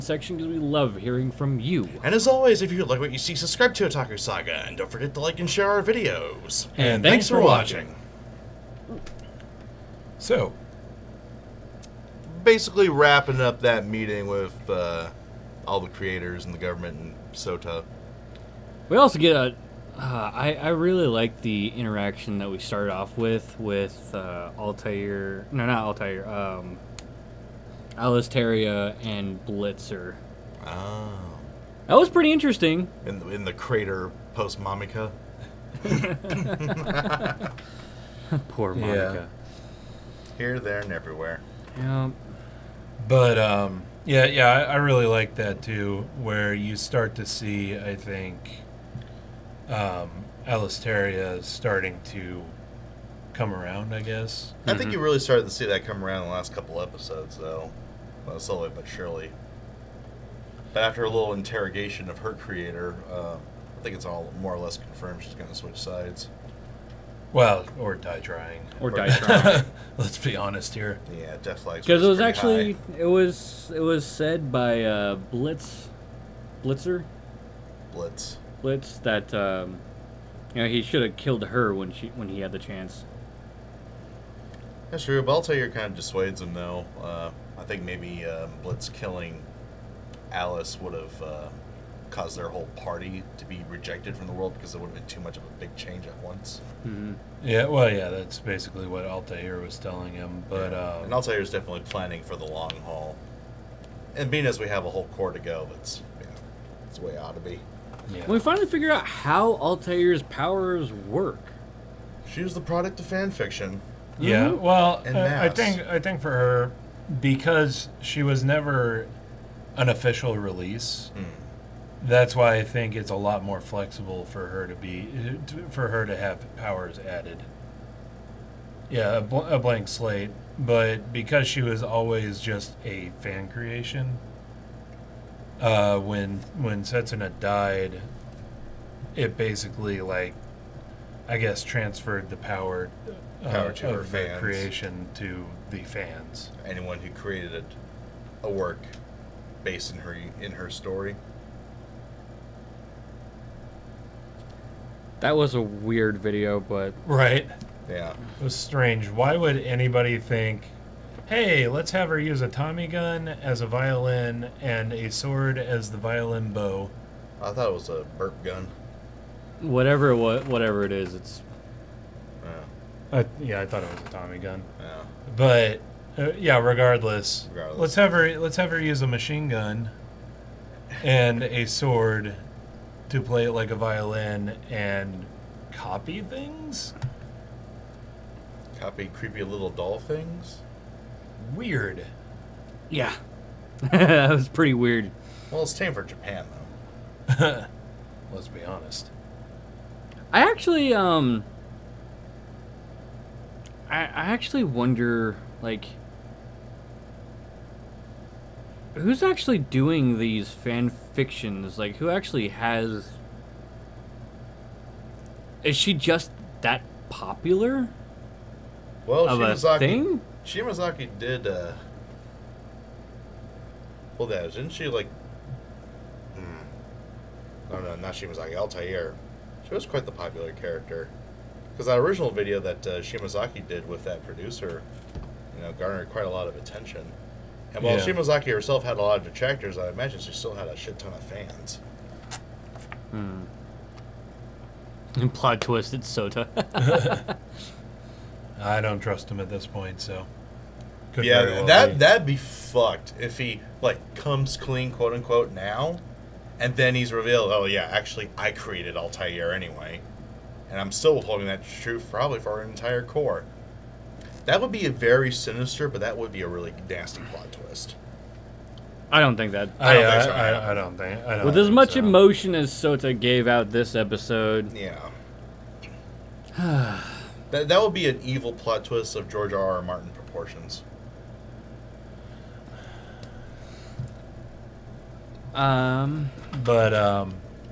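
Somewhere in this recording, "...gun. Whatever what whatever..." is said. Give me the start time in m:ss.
2:48.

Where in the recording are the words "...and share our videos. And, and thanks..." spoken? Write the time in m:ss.
0:05.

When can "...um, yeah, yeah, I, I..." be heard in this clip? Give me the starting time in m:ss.
0:43.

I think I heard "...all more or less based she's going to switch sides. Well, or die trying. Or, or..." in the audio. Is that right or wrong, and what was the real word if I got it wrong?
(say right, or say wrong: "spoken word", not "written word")
wrong: "confirmed", not "based".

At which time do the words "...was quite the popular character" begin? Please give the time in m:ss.
3:49.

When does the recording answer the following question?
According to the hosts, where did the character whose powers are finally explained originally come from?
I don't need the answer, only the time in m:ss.
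1:53.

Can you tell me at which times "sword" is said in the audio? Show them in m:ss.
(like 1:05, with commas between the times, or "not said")
2:45, 3:01.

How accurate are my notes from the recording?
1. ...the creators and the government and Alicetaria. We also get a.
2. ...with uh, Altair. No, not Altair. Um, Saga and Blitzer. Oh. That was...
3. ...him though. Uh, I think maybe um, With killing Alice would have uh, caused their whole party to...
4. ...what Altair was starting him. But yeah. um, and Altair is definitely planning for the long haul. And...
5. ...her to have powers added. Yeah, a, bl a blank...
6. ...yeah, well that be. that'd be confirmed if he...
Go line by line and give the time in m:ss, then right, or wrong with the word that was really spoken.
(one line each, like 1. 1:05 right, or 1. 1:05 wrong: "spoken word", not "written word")
1. 0:15 wrong: "SOTA", not "Alicetaria"
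2. 0:23 wrong: "Alicetaria", not "Saga"
3. 1:26 wrong: "Blitz", not "With"
4. 1:38 wrong: "telling", not "starting"
5. 2:05 right
6. 4:11 wrong: "fucked", not "confirmed".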